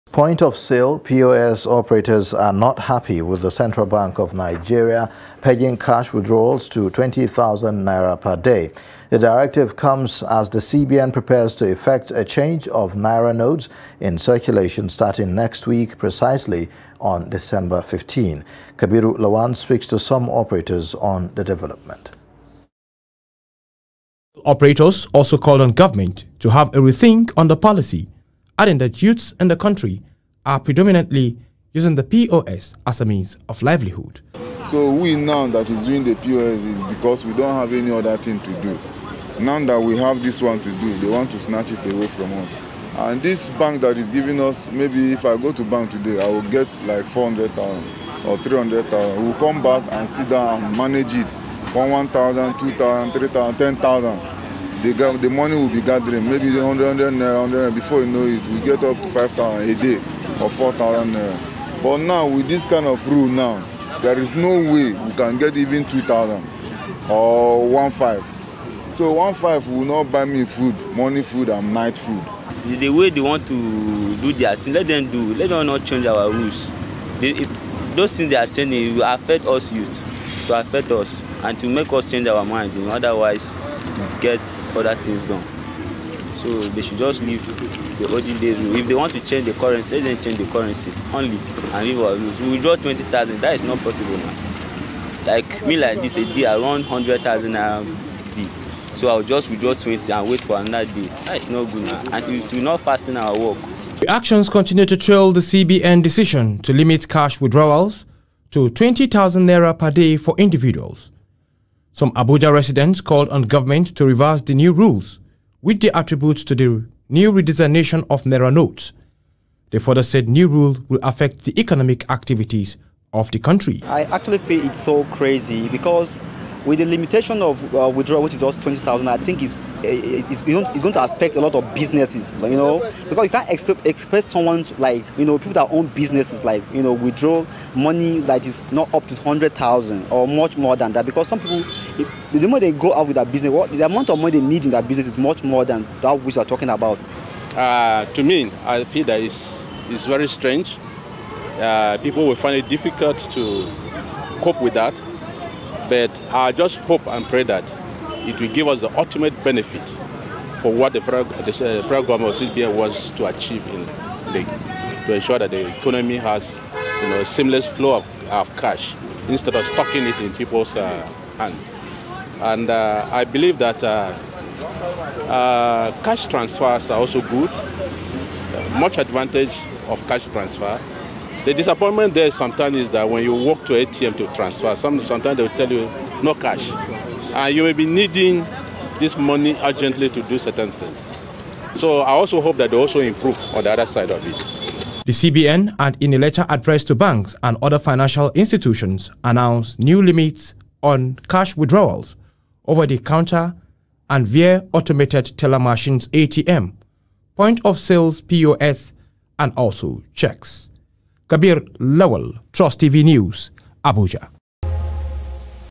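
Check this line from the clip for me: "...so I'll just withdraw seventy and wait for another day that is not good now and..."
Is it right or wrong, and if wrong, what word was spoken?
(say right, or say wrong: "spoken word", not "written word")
wrong: "twenty", not "seventy".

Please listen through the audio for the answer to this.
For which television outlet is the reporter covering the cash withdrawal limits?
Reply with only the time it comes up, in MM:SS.
03:32.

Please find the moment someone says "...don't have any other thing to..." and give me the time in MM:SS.
00:37.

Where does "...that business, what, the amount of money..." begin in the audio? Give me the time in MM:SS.
02:23.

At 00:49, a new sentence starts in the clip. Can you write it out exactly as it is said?
We'll come back and sit down and manage it.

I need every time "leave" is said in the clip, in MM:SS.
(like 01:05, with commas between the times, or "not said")
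01:27, 01:31.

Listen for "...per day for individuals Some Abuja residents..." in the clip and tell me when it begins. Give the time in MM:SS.
01:49.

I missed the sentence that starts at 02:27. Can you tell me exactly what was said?
Uh, to me, I feel that it's, it's very strange.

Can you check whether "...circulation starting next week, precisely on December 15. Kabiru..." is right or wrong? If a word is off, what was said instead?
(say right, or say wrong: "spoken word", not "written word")
right.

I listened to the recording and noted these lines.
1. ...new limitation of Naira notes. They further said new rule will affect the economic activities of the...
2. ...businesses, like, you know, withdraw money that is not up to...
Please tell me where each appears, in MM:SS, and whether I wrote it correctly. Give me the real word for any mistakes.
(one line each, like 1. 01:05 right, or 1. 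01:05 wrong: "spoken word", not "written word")
1. 01:57 wrong: "redesignation", not "limitation"
2. 02:15 right.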